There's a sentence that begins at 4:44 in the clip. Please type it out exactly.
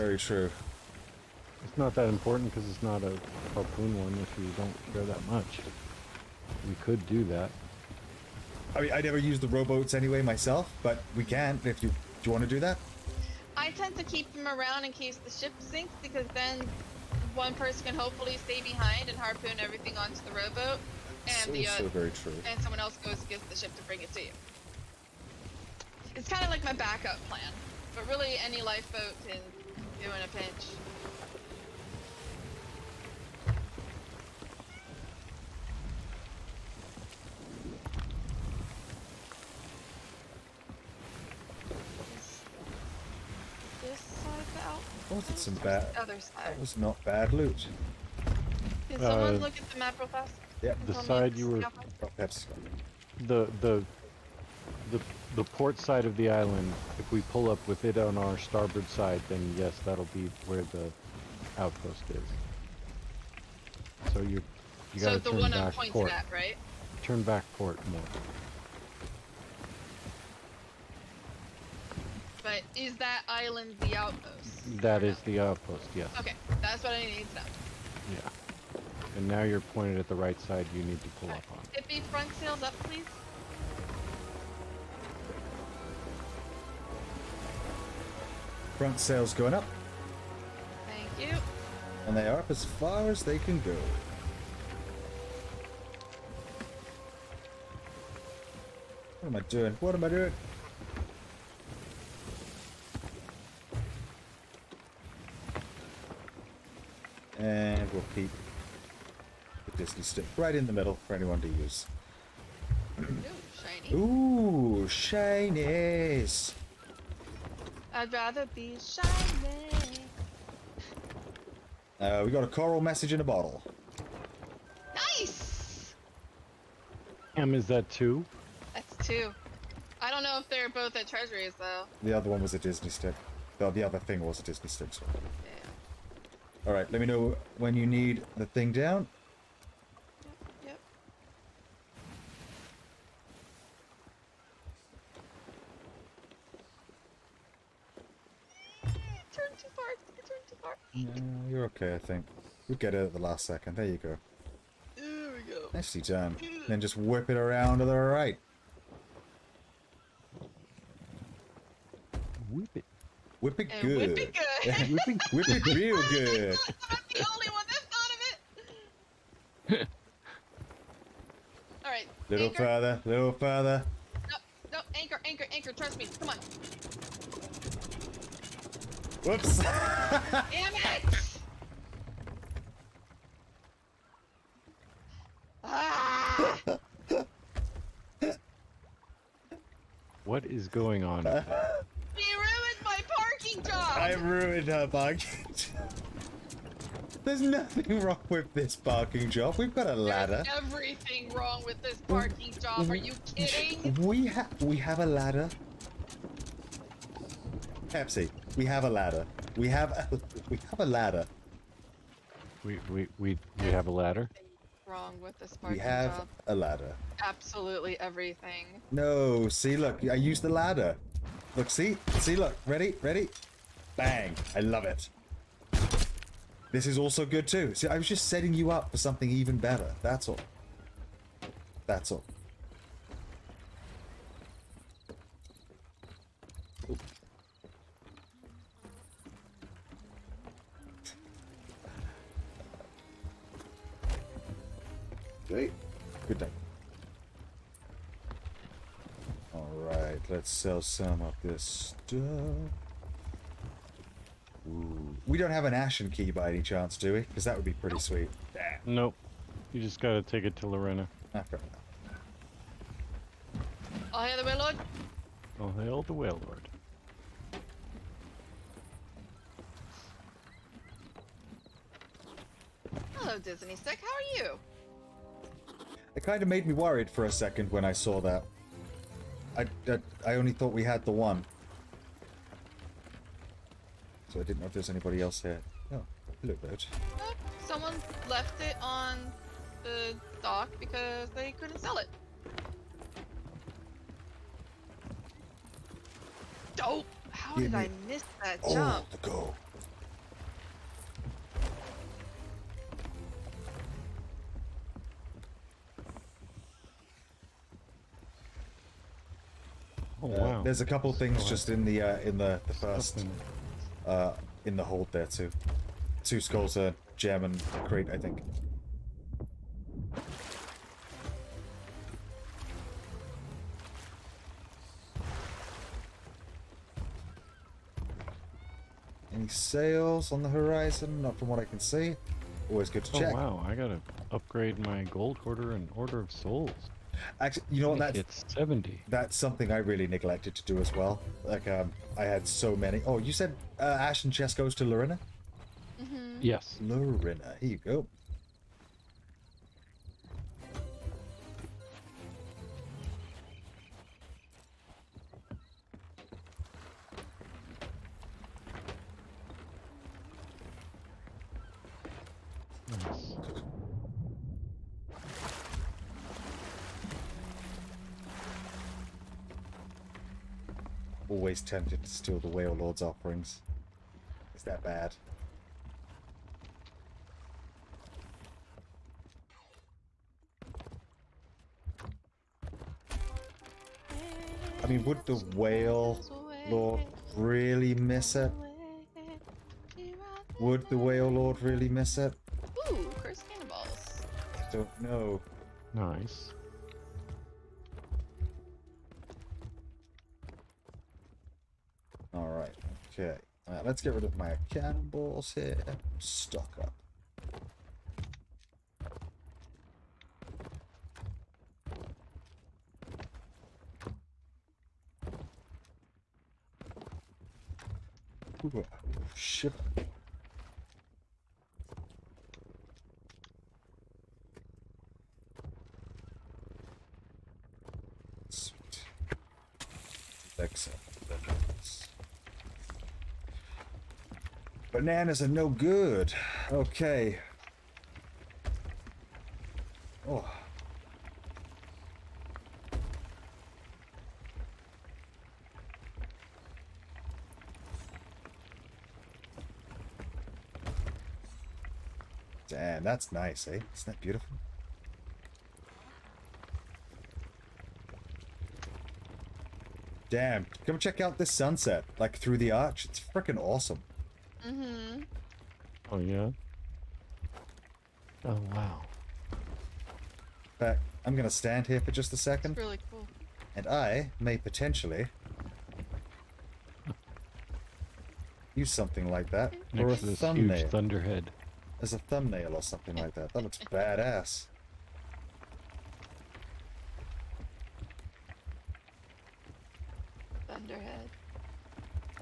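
So I didn't know if there's anybody else here.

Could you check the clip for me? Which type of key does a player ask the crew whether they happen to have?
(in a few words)
Ashen key.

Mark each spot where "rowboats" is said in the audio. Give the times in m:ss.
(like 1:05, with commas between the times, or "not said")
0:09, 0:20.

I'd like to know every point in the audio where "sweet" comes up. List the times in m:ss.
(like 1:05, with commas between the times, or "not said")
4:17, 7:08.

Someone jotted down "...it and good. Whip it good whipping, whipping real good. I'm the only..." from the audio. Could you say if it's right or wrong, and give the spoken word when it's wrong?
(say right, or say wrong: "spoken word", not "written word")
right.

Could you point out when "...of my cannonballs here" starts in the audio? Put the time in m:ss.
6:44.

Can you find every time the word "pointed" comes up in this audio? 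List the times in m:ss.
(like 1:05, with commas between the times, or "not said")
1:19.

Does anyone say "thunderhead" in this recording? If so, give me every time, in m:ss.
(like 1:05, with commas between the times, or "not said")
8:00, 8:10.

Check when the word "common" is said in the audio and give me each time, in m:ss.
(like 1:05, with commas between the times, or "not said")
not said.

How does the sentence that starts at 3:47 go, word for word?
See, I was just setting you up for something even better.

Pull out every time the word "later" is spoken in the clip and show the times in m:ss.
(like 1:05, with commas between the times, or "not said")
not said.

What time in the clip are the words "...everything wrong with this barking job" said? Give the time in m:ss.
3:20.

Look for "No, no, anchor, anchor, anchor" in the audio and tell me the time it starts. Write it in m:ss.
2:54.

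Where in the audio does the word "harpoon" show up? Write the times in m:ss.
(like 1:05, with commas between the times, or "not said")
0:03, 0:19.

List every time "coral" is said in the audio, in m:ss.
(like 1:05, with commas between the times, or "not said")
2:02.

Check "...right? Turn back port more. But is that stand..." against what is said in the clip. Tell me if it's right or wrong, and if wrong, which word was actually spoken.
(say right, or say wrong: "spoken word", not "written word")
wrong: "island", not "stand".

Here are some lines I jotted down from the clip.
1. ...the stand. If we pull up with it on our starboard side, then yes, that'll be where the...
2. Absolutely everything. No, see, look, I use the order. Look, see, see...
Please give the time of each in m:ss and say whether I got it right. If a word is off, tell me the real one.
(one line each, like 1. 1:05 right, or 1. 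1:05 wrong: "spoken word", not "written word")
1. 0:56 wrong: "island", not "stand"
2. 3:37 wrong: "ladder", not "order".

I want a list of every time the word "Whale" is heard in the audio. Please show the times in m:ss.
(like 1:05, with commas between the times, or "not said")
6:12, 6:25, 6:30.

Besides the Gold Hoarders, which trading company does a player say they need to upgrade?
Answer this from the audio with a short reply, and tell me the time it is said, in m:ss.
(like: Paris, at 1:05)
Order of Souls, at 5:35.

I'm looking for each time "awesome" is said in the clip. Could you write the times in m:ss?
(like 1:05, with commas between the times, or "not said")
7:43.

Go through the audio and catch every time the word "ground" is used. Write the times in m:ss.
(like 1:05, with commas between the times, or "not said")
not said.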